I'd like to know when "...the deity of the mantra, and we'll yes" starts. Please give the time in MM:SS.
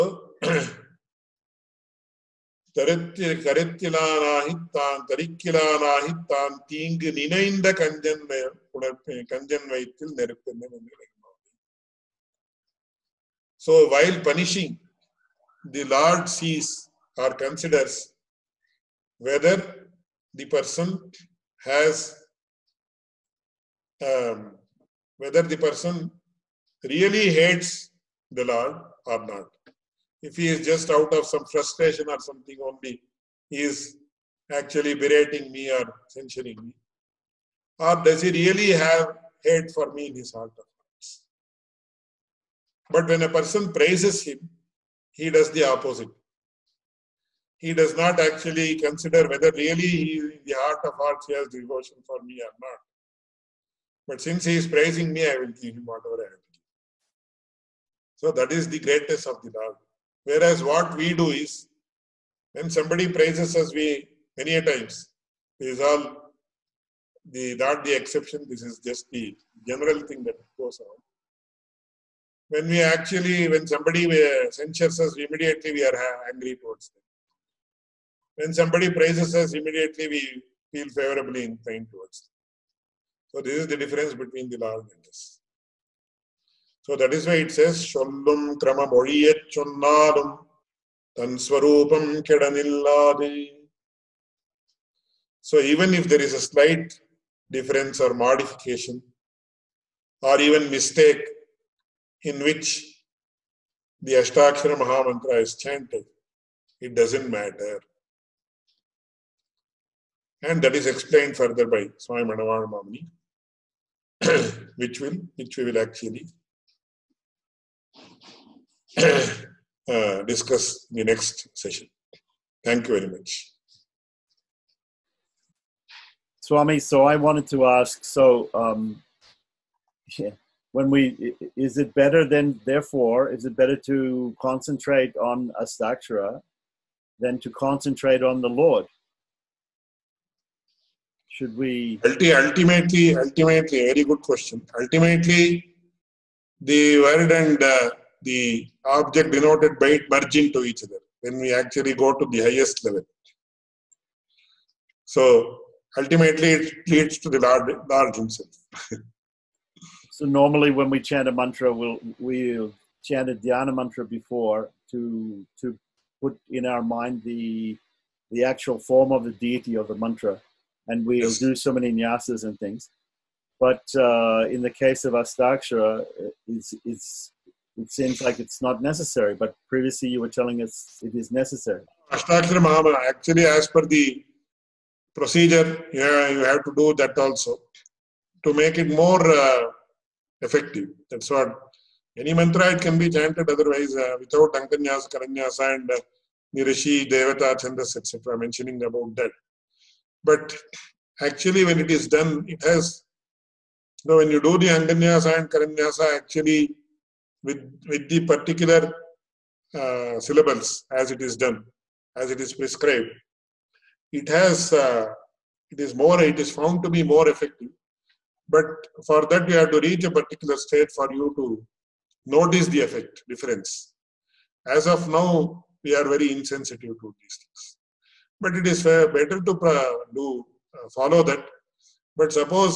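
02:49.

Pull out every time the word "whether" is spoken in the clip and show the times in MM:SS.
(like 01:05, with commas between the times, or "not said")
00:19, 00:25, 00:49.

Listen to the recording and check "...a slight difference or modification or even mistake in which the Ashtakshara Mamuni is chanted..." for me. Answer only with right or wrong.
wrong.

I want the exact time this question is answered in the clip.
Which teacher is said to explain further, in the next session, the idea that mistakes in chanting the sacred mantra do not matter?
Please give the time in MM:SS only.
01:51.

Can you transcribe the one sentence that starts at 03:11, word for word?
That's what any mantra it can be chanted otherwise uh, without Anganyasa, Karanyasa, and uh, Nirishi, Devata, Chandas, etc.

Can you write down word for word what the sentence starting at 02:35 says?
So ultimately, it leads to the Lord, Lord Himself.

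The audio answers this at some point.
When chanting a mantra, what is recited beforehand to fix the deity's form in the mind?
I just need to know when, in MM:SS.
02:43.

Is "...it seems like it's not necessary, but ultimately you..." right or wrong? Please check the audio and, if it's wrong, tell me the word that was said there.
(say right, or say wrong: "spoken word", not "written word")
wrong: "previously", not "ultimately".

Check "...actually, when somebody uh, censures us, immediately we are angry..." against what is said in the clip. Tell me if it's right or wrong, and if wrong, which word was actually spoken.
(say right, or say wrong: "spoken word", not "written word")
right.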